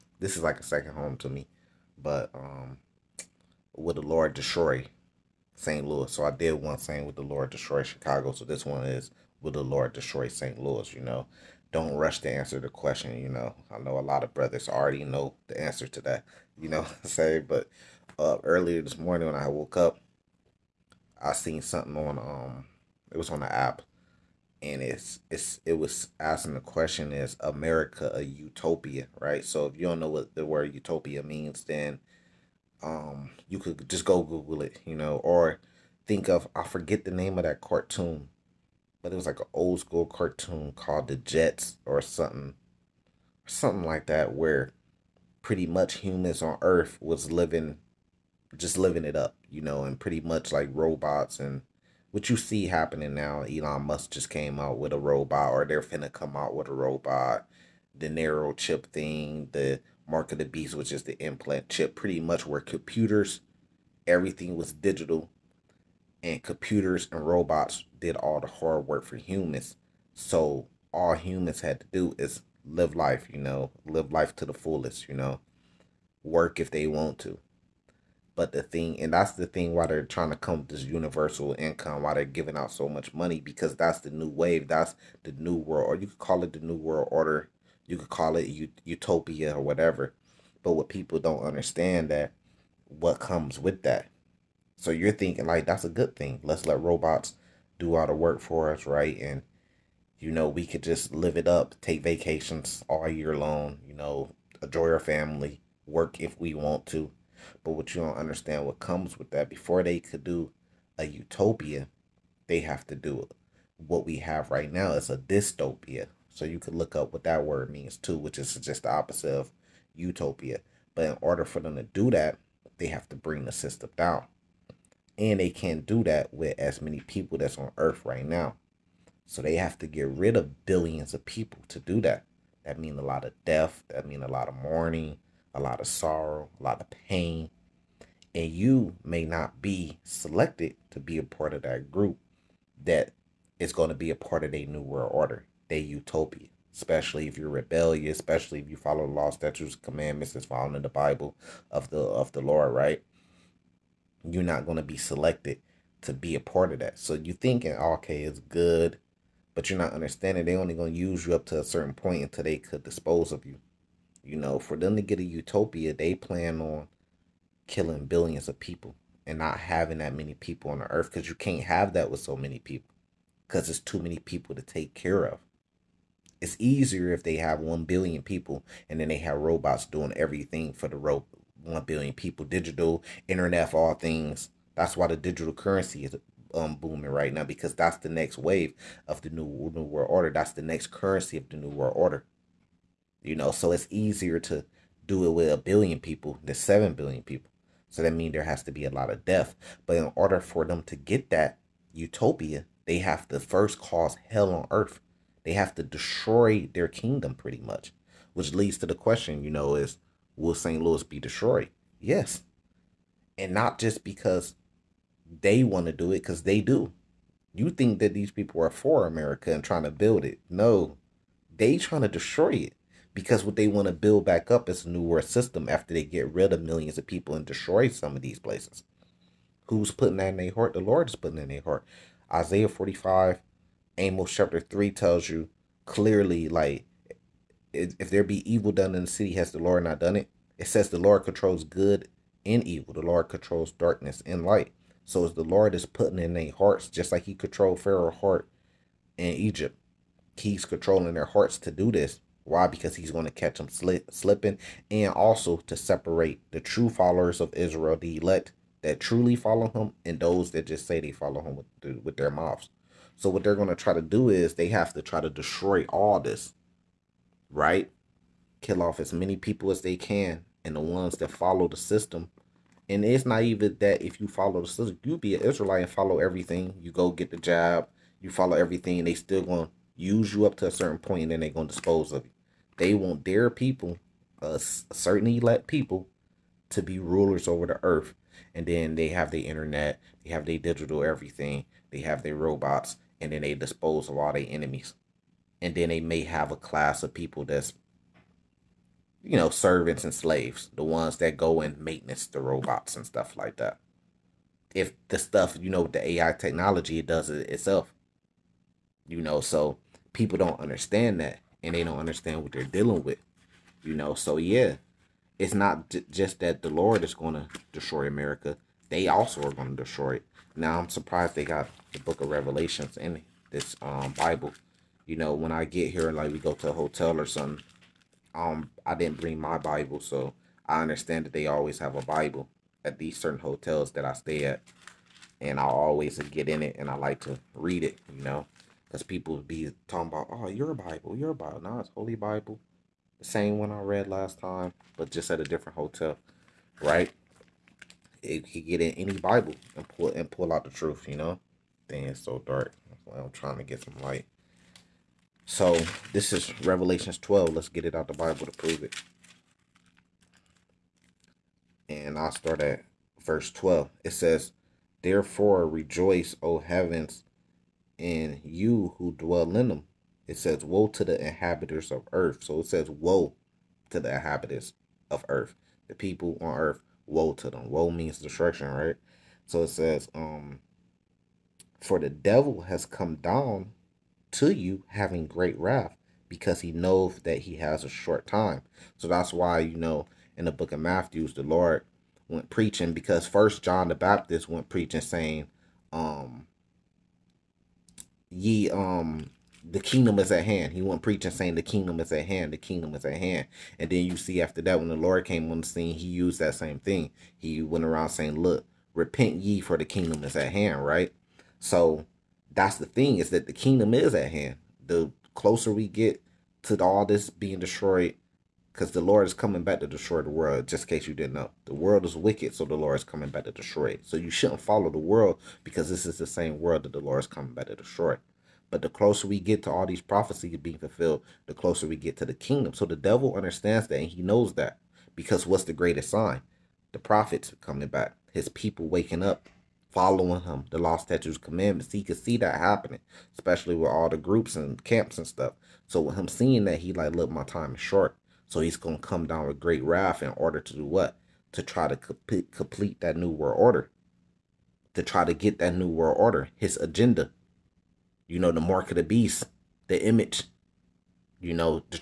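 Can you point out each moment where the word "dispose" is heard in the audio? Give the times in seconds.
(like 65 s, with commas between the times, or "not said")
162 s, 281 s, 293 s.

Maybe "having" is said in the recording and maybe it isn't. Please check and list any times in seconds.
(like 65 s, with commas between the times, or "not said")
169 s, 384 s.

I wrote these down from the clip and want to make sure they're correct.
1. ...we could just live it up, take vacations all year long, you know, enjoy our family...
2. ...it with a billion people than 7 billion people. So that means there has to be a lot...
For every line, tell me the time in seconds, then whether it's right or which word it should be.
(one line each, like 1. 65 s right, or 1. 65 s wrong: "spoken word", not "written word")
1. 100 s right
2. 195 s right.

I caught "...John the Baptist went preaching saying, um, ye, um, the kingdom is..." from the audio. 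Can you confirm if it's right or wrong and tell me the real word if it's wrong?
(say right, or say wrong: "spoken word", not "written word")
right.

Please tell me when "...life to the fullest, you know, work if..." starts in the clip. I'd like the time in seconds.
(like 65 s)
74 s.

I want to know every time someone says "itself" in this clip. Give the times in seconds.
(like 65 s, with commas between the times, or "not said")
307 s.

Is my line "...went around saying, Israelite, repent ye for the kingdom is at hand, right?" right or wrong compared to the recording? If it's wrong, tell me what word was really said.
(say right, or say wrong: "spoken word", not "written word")
wrong: "Look", not "Israelite".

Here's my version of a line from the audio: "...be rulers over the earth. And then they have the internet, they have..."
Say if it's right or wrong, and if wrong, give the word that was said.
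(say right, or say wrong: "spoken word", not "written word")
right.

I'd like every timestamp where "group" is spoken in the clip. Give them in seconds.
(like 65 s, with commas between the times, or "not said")
141 s, 444 s.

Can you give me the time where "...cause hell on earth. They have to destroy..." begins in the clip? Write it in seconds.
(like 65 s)
203 s.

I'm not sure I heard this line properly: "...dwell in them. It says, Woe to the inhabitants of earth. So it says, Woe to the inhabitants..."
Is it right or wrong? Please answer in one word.
right.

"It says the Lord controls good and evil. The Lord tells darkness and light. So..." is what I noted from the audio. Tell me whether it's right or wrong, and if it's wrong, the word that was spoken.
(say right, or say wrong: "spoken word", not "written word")
wrong: "controls", not "tells".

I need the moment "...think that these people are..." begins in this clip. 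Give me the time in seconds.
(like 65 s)
217 s.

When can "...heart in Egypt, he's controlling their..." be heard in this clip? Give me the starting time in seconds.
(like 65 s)
248 s.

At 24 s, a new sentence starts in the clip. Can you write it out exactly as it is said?
And it's it's it was asking the question is America a utopia, right?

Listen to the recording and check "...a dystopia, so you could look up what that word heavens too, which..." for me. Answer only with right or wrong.
wrong.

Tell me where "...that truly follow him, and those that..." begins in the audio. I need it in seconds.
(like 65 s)
258 s.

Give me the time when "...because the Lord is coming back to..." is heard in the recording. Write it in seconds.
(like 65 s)
418 s.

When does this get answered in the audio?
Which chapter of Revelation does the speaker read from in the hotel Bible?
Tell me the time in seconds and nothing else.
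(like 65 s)
356 s.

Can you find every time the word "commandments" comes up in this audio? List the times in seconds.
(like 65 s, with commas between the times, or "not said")
149 s, 441 s.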